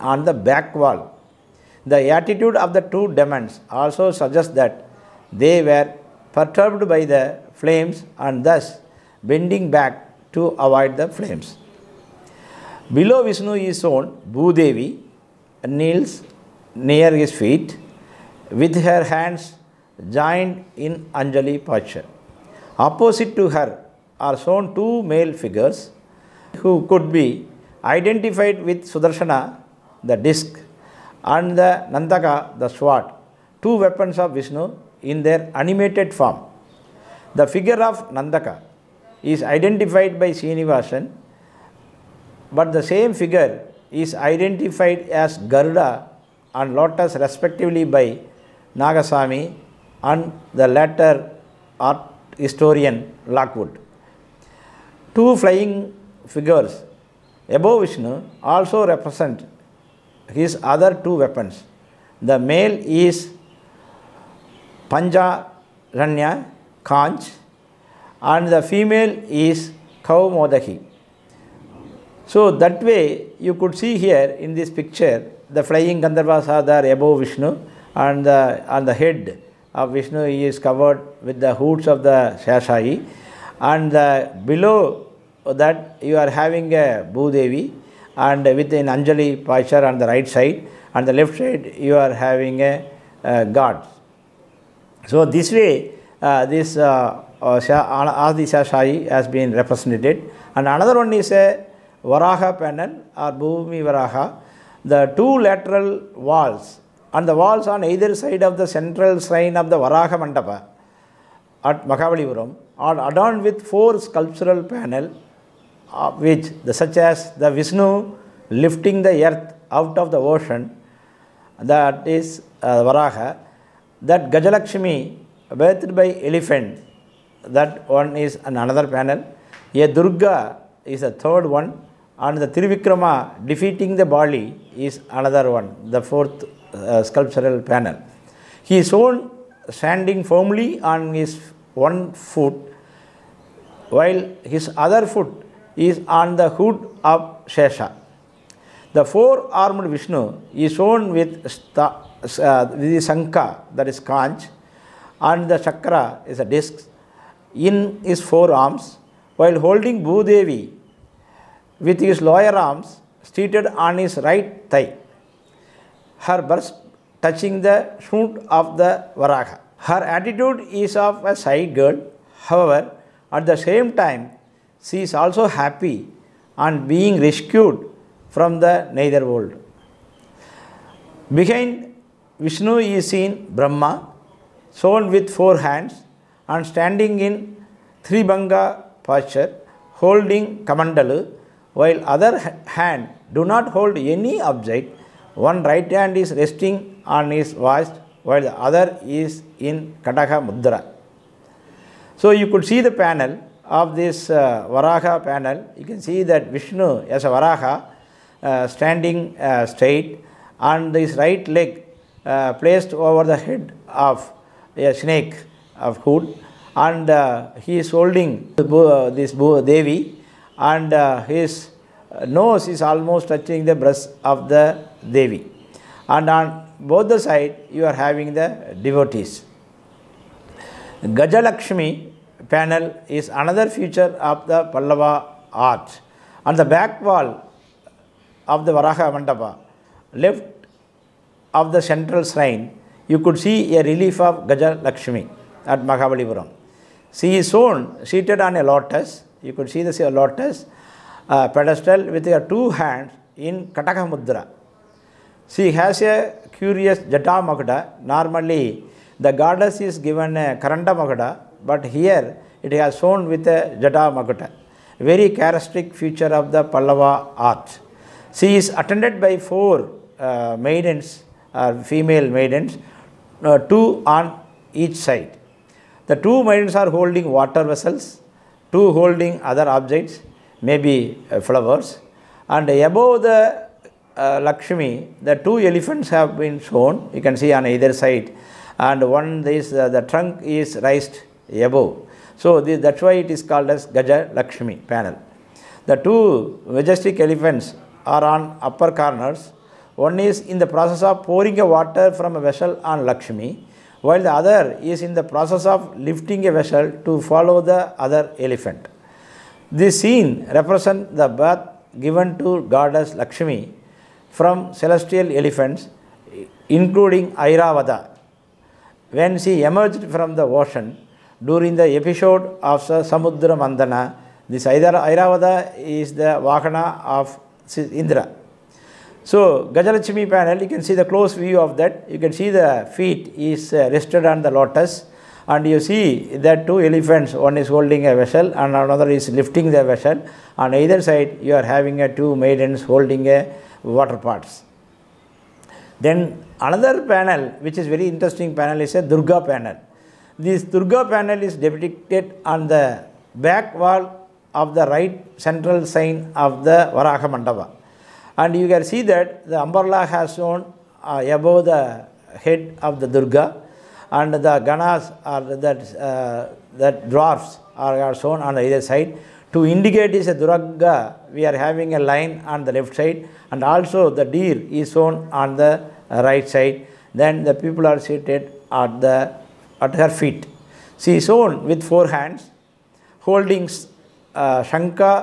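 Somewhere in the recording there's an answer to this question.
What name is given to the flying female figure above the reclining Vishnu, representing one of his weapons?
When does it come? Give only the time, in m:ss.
1:10.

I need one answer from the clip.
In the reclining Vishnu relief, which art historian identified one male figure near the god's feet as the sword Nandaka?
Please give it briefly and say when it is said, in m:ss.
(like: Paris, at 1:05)
Srinivasan, at 0:40.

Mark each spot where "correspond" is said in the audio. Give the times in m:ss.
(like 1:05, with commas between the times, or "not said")
not said.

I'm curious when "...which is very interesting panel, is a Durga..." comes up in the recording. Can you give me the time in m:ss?
5:47.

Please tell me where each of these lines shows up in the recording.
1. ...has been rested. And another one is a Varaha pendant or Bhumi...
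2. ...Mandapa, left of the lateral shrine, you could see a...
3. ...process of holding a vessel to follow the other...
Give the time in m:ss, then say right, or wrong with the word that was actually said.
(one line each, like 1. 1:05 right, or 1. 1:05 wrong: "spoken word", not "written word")
1. 1:39 wrong: "represented", not "rested"
2. 3:59 wrong: "central", not "lateral"
3. 5:05 wrong: "lifting", not "holding".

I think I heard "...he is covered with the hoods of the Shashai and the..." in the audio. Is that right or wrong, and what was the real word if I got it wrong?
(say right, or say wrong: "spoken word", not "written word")
right.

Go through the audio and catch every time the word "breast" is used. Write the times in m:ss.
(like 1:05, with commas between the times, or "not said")
2:46, 3:43.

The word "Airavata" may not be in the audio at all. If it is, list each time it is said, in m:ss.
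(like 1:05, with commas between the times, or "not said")
5:17, 5:24.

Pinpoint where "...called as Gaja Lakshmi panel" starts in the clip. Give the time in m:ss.
4:53.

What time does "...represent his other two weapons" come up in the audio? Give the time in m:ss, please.
0:58.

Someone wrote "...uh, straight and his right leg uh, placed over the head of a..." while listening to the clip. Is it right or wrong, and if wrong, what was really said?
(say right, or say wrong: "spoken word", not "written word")
right.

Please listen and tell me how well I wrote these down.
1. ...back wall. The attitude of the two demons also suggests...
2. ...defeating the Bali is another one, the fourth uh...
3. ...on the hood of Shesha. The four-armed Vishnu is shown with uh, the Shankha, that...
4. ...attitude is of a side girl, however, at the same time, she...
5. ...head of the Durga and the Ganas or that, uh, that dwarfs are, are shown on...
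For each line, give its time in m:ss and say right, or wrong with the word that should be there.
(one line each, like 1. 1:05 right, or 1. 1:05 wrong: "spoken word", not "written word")
1. 0:00 right
2. 2:13 right
3. 2:26 right
4. 2:50 right
5. 6:02 right.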